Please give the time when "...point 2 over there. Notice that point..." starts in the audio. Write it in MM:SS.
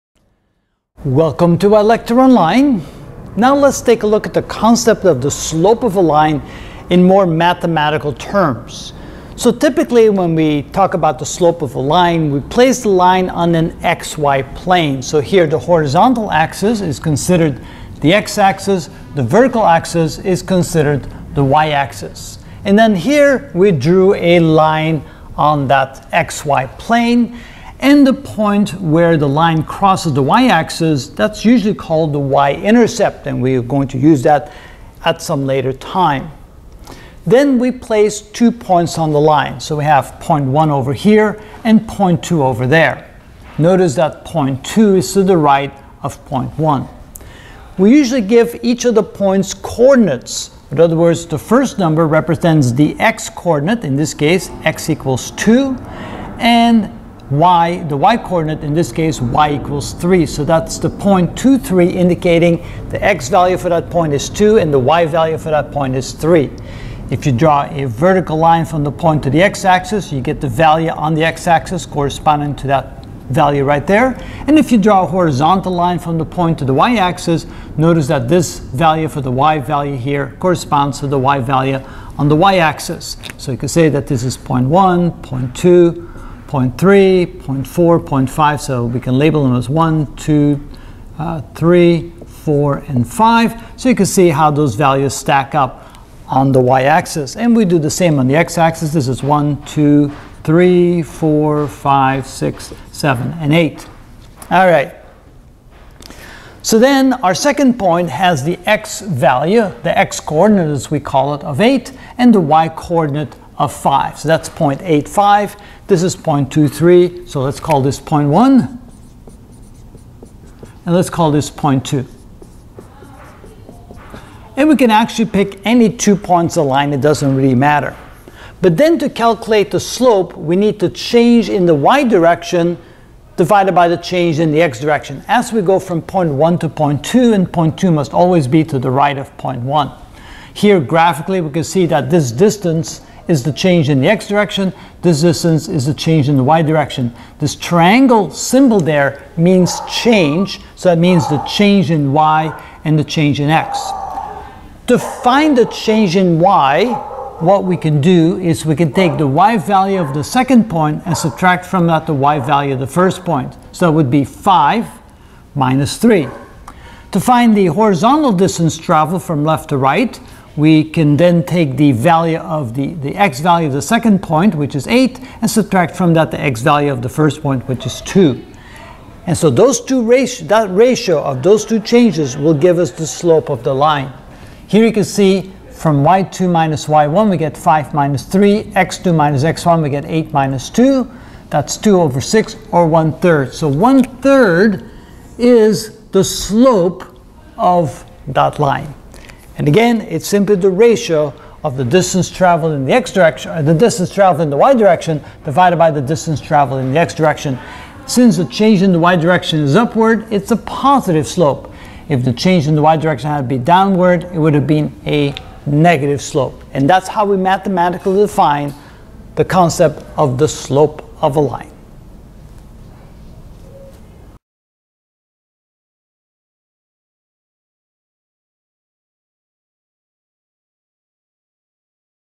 00:41.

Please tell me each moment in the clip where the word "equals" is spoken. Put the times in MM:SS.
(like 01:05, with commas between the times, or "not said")
00:54, 00:59.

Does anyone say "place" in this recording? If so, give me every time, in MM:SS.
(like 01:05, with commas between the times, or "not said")
00:12, 00:37.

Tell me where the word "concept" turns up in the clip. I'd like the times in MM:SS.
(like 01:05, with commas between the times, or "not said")
00:04, 03:39.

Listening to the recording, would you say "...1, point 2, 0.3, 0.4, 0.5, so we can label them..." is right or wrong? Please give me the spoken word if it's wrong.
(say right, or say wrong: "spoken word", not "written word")
right.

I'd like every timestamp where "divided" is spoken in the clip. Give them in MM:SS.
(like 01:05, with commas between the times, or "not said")
02:13, 03:25.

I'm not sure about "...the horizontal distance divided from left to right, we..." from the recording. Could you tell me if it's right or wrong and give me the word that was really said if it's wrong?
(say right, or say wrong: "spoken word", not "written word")
wrong: "traveled", not "divided".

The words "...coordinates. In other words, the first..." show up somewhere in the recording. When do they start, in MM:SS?
00:49.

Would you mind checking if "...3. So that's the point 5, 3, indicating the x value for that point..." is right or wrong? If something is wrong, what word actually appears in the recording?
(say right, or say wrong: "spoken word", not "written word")
wrong: "2", not "5".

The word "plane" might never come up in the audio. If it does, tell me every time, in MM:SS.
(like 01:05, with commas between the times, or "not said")
00:14, 00:26.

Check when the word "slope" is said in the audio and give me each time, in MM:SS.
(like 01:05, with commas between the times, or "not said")
00:05, 00:11, 02:09, 03:03, 03:16, 03:31, 03:36, 03:40.